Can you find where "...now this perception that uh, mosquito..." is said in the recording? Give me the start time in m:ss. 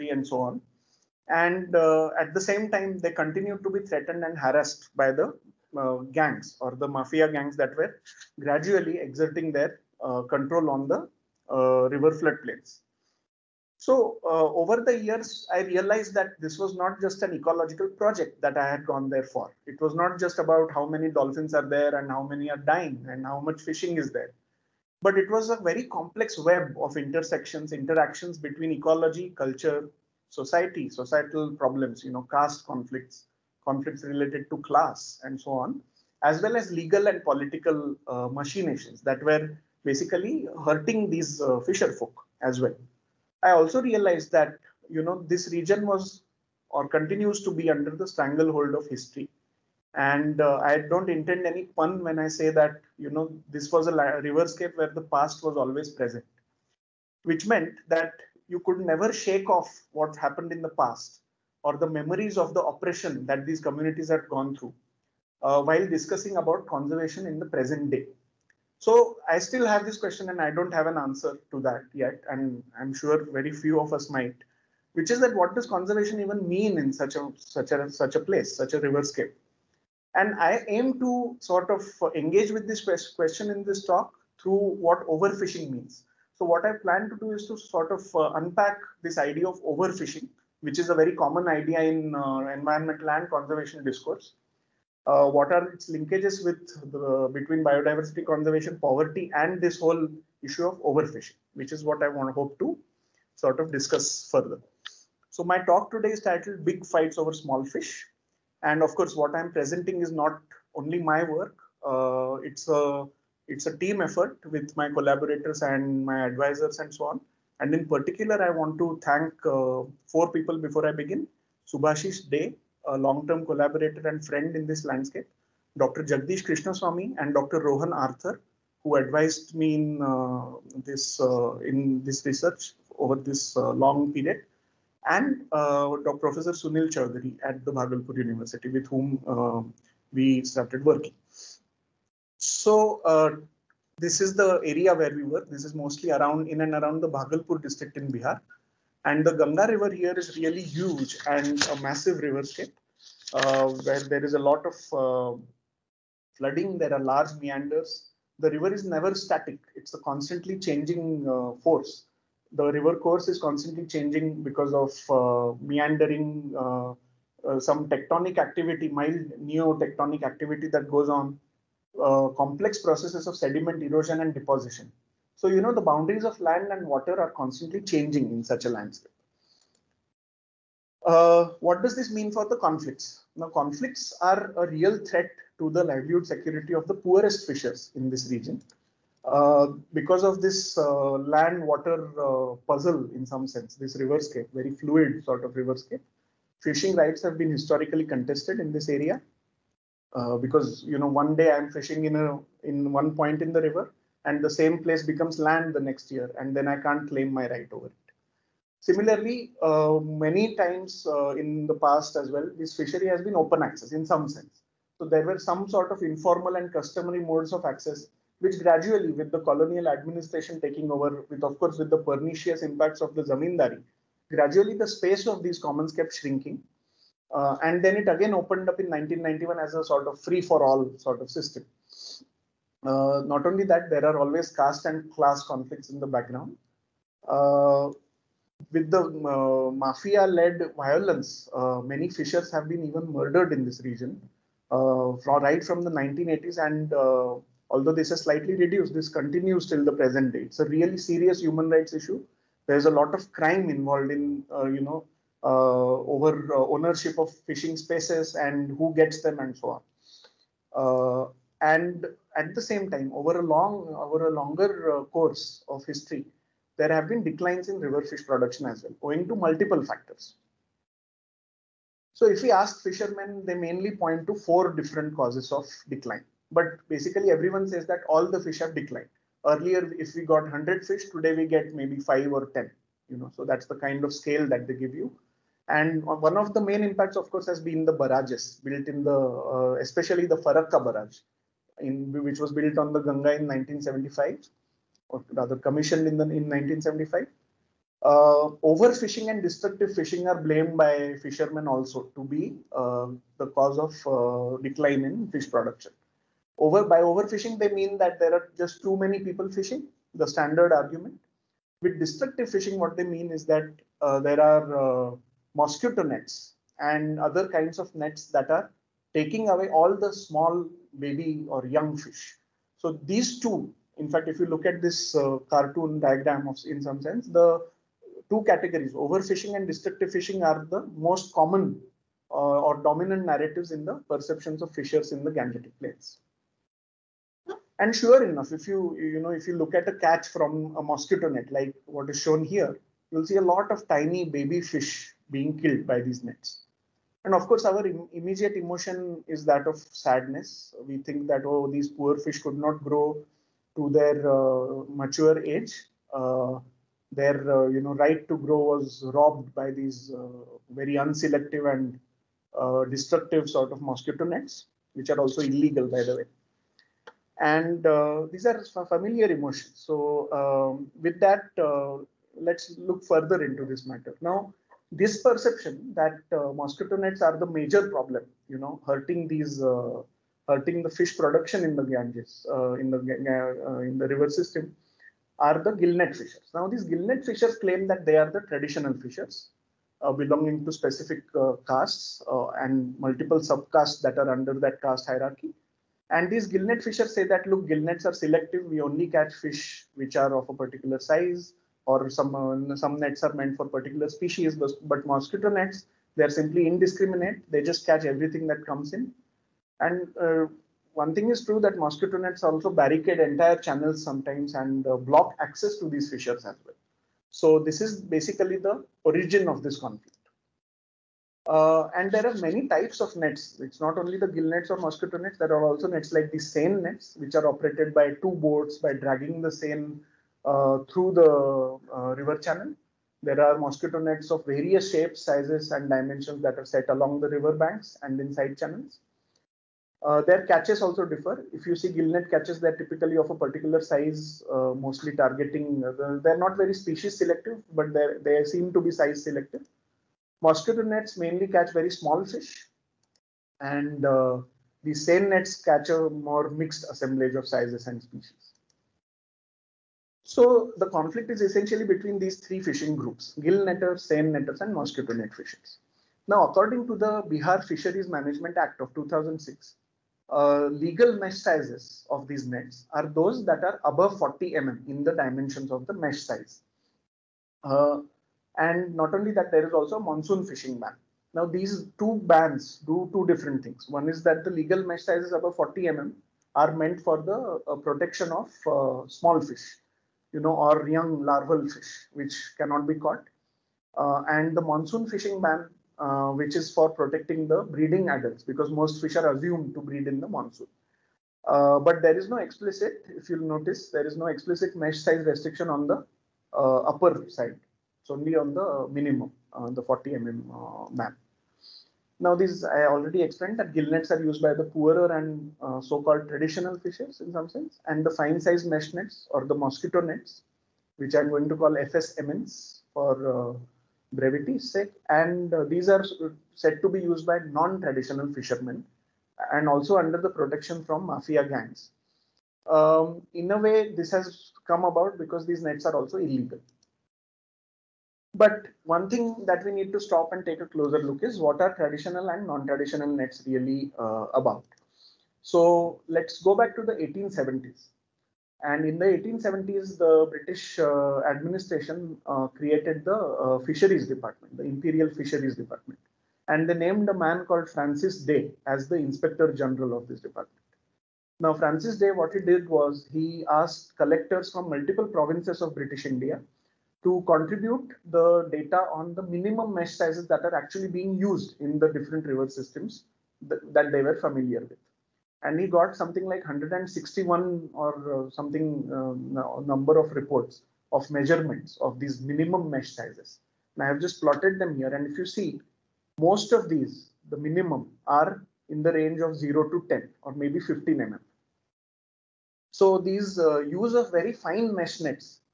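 6:14.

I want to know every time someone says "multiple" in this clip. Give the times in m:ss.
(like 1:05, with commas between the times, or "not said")
4:29, 6:32, 9:24.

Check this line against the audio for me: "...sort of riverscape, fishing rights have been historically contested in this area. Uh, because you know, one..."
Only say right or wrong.
right.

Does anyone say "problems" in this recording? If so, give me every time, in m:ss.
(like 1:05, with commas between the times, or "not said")
0:31, 6:17.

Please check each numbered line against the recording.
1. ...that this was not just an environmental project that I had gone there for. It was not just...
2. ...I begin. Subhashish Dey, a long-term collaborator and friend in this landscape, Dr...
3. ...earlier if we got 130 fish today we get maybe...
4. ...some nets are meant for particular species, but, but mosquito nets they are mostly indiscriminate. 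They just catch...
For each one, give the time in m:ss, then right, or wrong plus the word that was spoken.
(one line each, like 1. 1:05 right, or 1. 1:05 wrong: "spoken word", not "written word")
1. 0:16 wrong: "ecological", not "environmental"
2. 2:00 right
3. 4:39 wrong: "100", not "130"
4. 6:42 wrong: "simply", not "mostly".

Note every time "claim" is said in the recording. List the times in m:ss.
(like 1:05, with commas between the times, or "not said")
3:27, 6:27.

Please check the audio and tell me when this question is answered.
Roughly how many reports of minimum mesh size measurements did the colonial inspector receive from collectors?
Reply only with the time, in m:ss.
9:36.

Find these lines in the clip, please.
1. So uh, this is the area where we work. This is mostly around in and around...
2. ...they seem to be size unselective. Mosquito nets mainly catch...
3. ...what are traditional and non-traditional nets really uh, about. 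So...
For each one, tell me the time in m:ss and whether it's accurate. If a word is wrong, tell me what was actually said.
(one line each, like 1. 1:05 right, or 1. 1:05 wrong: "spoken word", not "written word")
1. 2:22 right
2. 7:28 wrong: "selective", not "unselective"
3. 9:01 right.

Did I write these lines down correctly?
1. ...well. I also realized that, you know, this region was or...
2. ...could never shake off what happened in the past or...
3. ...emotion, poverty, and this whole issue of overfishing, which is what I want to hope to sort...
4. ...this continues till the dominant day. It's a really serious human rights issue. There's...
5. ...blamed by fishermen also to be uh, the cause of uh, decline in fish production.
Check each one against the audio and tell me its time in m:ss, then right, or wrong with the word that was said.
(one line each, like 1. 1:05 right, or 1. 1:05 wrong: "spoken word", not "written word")
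1. 0:42 right
2. 0:58 right
3. 1:38 wrong: "conservation", not "emotion"
4. 4:08 wrong: "present", not "dominant"
5. 5:00 right.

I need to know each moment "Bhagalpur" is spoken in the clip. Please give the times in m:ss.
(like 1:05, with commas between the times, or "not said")
2:17, 2:27.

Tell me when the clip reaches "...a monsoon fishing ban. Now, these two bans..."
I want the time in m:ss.
7:59.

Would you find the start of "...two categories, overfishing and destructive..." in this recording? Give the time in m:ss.
5:28.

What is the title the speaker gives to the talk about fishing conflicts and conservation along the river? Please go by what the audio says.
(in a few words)
Big Fights Over Small Fish.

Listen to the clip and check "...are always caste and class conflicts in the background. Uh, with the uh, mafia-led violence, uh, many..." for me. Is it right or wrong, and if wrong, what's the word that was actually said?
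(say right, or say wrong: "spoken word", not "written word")
right.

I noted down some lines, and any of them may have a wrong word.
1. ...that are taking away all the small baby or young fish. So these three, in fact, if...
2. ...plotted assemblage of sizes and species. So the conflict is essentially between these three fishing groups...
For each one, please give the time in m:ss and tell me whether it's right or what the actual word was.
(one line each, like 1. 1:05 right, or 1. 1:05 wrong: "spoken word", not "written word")
1. 5:18 wrong: "two", not "three"
2. 7:36 wrong: "mixed", not "plotted".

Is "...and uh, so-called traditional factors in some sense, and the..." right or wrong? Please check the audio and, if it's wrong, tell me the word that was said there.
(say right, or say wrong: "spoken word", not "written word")
wrong: "fishers", not "factors".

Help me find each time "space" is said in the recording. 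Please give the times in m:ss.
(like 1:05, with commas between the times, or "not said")
3:44, 4:17.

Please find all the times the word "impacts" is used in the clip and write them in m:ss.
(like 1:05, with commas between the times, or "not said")
3:42, 4:46.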